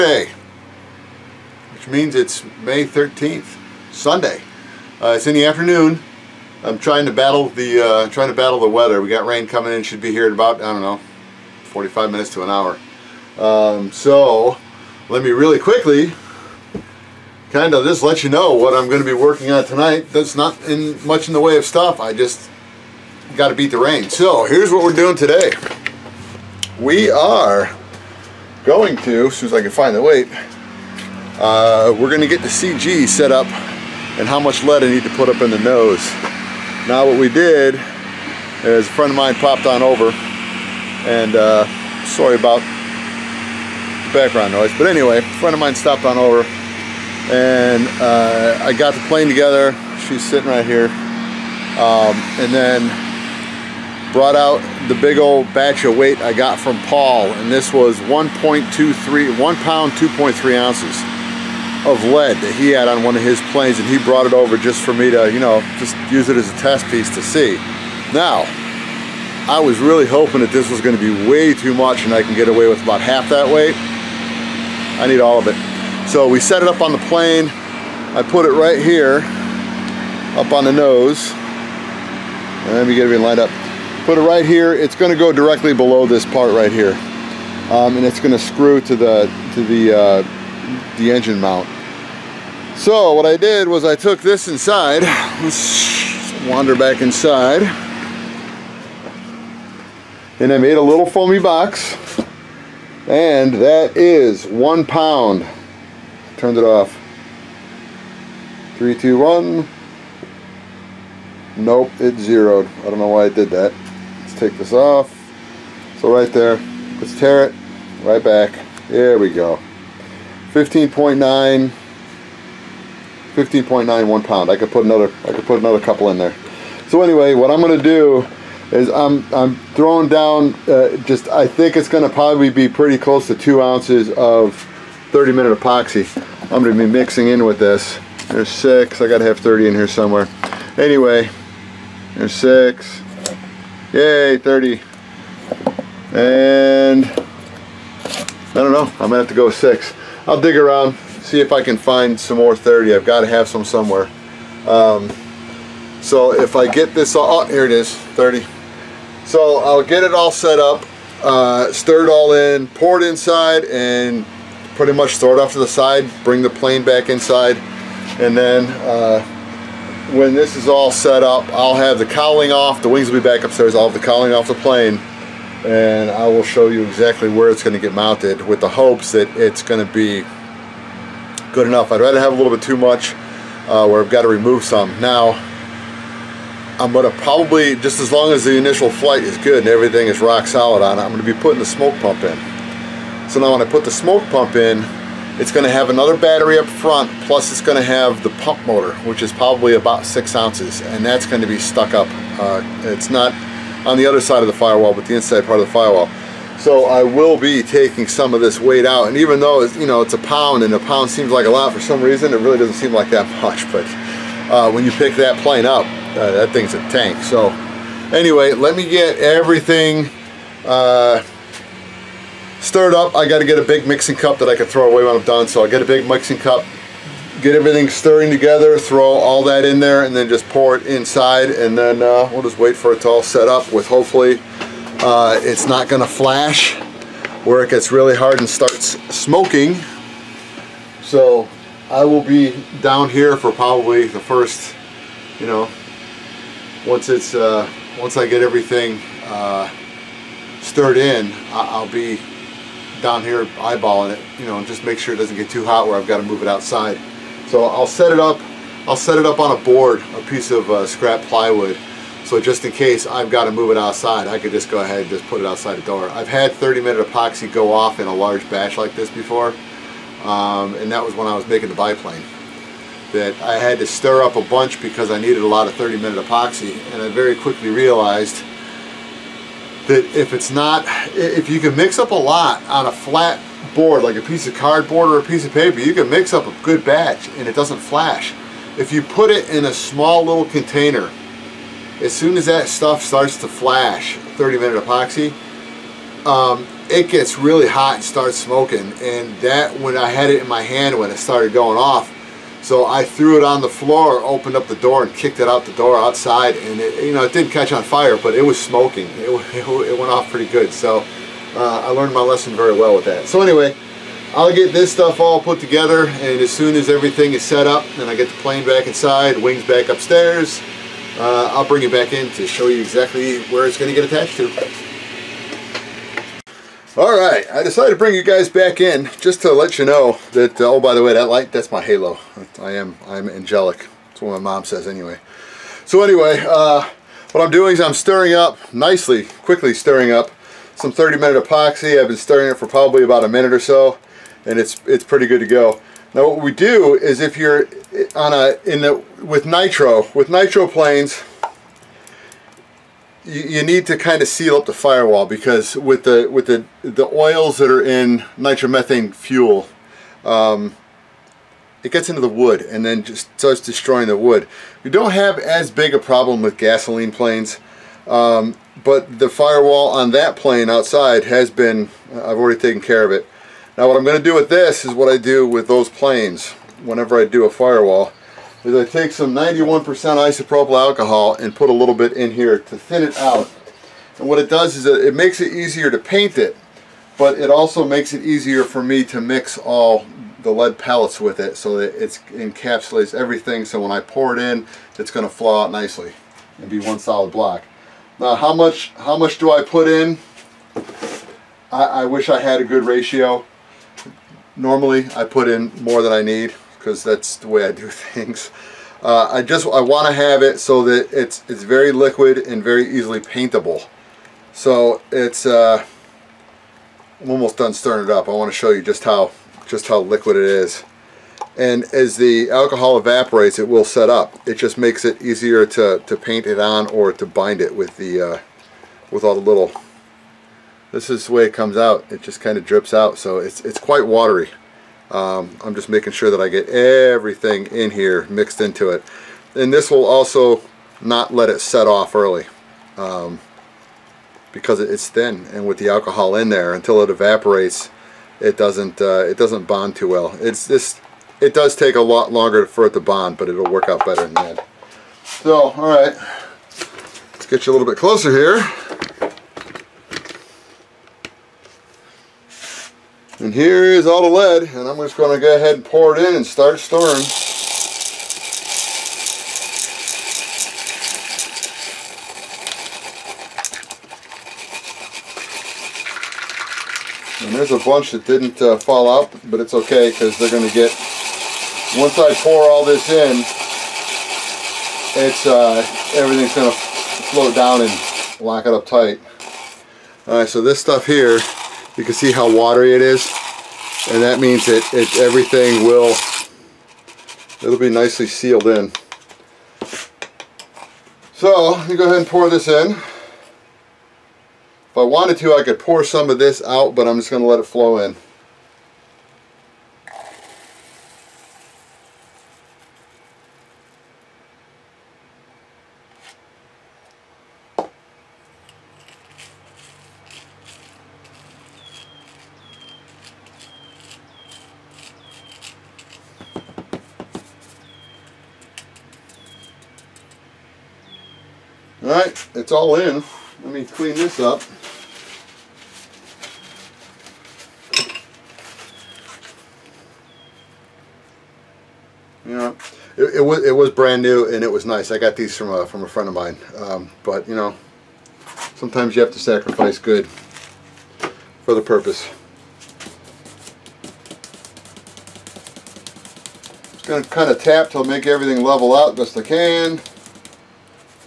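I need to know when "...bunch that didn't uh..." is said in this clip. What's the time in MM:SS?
07:57.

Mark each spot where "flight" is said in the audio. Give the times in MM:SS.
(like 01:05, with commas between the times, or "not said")
03:08.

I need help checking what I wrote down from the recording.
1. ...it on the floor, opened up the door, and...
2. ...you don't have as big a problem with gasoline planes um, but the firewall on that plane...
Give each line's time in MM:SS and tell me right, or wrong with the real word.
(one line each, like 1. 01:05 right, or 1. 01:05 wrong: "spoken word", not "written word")
1. 05:03 right
2. 06:04 right.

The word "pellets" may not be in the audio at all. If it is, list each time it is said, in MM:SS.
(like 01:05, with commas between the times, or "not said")
06:30.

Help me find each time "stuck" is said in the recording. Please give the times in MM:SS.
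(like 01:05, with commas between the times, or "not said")
03:21.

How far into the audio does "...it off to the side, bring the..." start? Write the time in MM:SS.
02:45.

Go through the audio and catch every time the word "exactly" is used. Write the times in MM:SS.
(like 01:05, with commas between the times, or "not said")
02:56, 05:22.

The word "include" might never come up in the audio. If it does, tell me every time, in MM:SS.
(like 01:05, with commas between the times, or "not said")
not said.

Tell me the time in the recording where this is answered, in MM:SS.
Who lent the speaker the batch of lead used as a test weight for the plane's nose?
00:56.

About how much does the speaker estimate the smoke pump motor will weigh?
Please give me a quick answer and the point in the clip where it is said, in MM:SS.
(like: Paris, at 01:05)
6 ounces, at 03:20.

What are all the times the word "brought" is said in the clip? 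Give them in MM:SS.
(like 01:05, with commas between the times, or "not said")
00:54, 01:03.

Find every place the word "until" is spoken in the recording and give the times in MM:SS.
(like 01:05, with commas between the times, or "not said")
07:26.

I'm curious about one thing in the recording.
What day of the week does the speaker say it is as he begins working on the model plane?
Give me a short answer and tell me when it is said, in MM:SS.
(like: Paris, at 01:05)
Sunday, at 00:03.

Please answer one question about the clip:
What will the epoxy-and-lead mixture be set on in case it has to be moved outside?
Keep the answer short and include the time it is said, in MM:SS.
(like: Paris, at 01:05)
scrap plywood, at 04:20.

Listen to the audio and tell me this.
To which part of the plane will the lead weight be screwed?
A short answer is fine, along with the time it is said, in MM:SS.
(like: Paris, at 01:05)
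the engine mount, at 01:30.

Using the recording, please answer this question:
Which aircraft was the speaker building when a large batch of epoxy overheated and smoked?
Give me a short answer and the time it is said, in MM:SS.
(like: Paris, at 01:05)
the biplane, at 04:31.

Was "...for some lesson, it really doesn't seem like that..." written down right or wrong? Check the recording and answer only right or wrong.
wrong.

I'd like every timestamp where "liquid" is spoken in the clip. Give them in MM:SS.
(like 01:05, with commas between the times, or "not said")
06:51, 07:00.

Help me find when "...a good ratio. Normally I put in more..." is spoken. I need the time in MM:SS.
06:42.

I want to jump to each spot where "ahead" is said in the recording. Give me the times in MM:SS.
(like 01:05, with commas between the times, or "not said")
04:24, 07:45, 08:22.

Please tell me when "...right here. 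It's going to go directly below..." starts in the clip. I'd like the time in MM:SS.
01:24.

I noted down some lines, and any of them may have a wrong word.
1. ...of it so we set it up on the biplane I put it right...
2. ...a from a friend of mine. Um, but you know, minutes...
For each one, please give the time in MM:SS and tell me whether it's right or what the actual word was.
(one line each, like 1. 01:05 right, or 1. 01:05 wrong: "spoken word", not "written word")
1. 01:15 wrong: "plane", not "biplane"
2. 09:05 wrong: "sometimes", not "minutes".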